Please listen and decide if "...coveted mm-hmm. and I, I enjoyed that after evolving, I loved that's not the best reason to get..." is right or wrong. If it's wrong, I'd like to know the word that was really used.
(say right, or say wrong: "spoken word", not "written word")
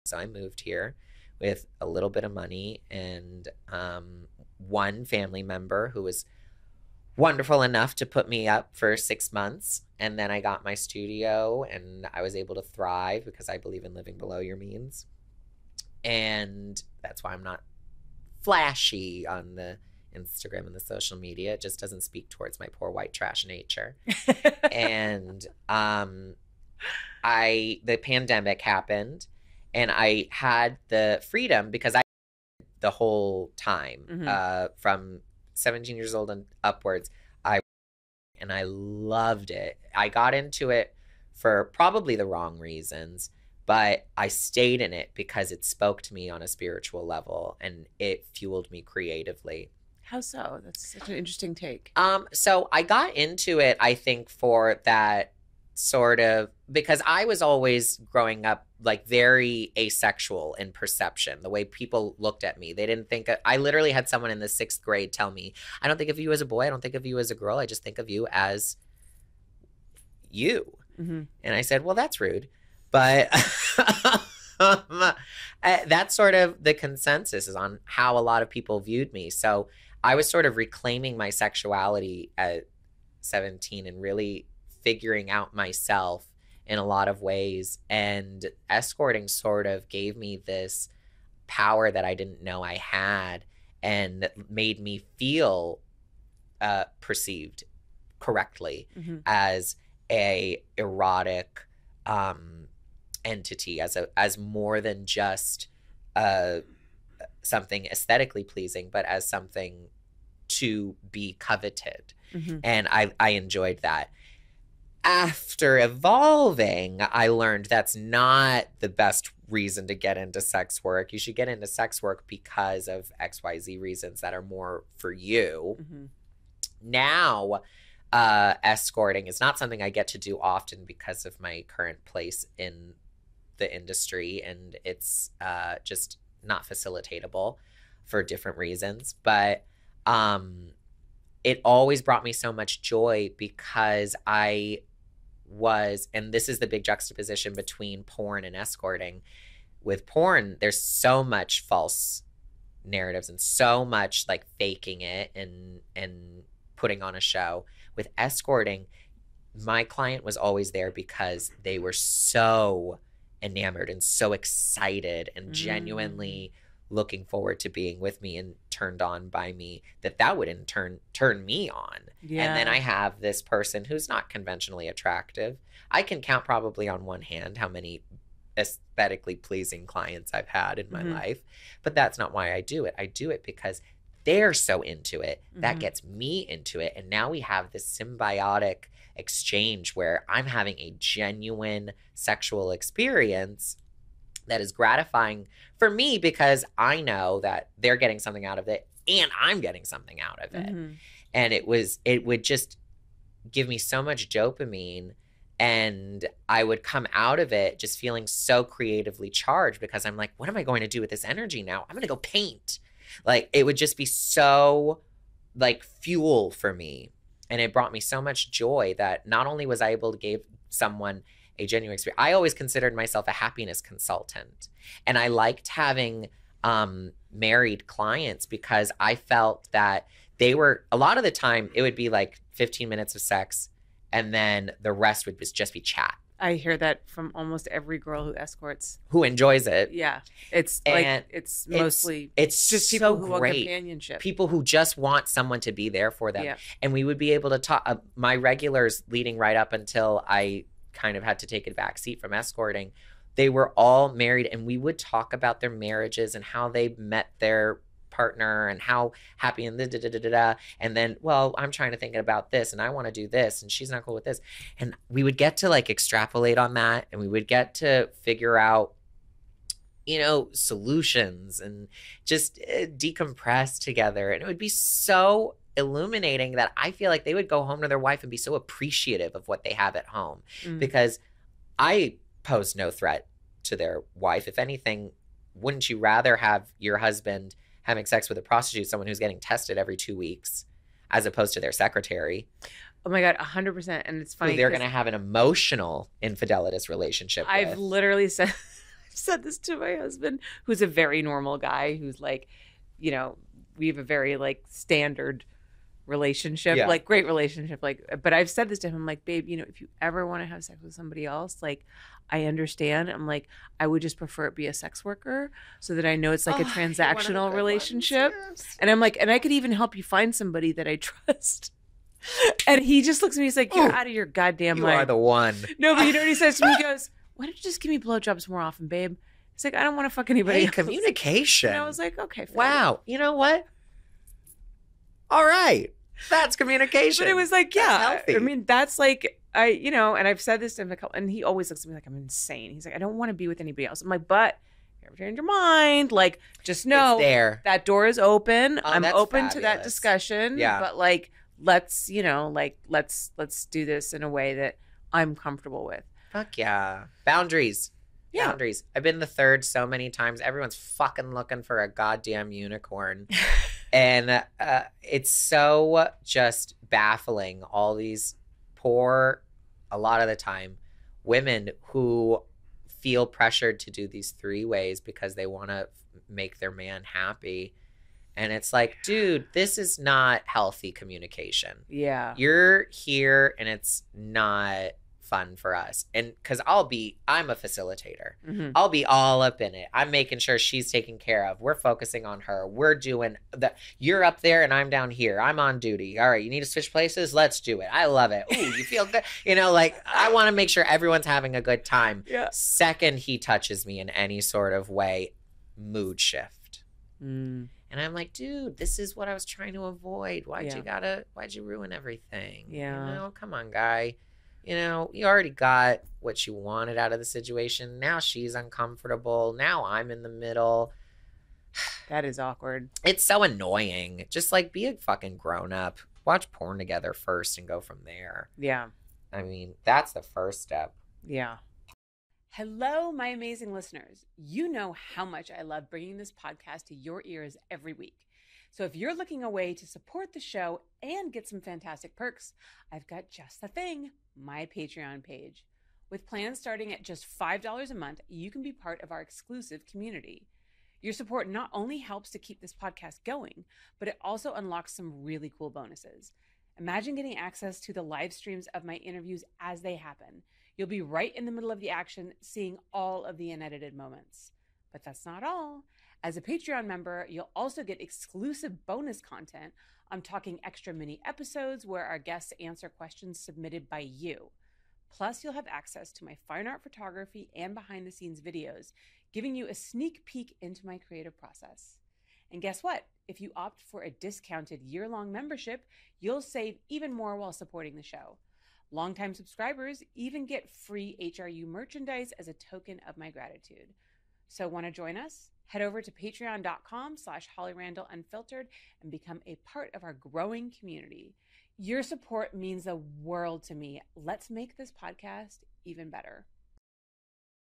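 wrong: "learned", not "loved".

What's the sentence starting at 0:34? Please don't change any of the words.
uh, from 17 years old and upwards.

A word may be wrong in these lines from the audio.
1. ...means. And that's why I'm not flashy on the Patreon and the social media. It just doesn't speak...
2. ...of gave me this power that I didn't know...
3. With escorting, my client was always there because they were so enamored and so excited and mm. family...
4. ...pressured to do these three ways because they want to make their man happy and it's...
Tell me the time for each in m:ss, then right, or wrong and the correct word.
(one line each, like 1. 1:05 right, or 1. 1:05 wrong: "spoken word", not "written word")
1. 0:14 wrong: "Instagram", not "Patreon"
2. 1:29 right
3. 2:37 wrong: "genuinely", not "family"
4. 6:13 right.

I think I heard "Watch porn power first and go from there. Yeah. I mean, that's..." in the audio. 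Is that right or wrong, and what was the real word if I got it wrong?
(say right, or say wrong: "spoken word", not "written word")
wrong: "together", not "power".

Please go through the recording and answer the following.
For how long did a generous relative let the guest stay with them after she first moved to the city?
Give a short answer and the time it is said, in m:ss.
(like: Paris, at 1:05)
6 months, at 0:08.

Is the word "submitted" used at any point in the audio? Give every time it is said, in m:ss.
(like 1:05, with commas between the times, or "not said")
7:53.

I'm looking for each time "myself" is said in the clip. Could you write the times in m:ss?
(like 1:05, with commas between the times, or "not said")
1:25, 3:42.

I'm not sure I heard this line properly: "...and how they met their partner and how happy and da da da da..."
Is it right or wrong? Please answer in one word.
right.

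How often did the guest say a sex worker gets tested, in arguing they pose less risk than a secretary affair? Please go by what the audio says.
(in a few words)
every 2 weeks.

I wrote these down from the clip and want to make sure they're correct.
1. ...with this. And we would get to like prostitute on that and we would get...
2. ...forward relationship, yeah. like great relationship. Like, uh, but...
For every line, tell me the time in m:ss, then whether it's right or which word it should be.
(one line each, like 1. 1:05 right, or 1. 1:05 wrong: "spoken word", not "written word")
1. 4:24 wrong: "extrapolate", not "prostitute"
2. 5:04 wrong: "standard", not "forward".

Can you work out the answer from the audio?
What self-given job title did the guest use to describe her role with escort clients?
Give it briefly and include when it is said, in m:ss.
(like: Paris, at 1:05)
happiness consultant, at 3:43.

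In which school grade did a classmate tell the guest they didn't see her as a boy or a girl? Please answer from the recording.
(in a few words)
sixth grade.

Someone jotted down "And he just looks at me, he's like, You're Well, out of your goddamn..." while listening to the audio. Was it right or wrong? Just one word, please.
wrong.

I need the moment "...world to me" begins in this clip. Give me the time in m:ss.
8:23.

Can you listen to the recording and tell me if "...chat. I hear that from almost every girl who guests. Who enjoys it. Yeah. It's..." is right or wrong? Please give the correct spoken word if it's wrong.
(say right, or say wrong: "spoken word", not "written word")
wrong: "escorts", not "guests".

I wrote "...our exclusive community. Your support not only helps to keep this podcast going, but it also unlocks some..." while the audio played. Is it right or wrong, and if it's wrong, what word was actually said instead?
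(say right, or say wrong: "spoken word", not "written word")
right.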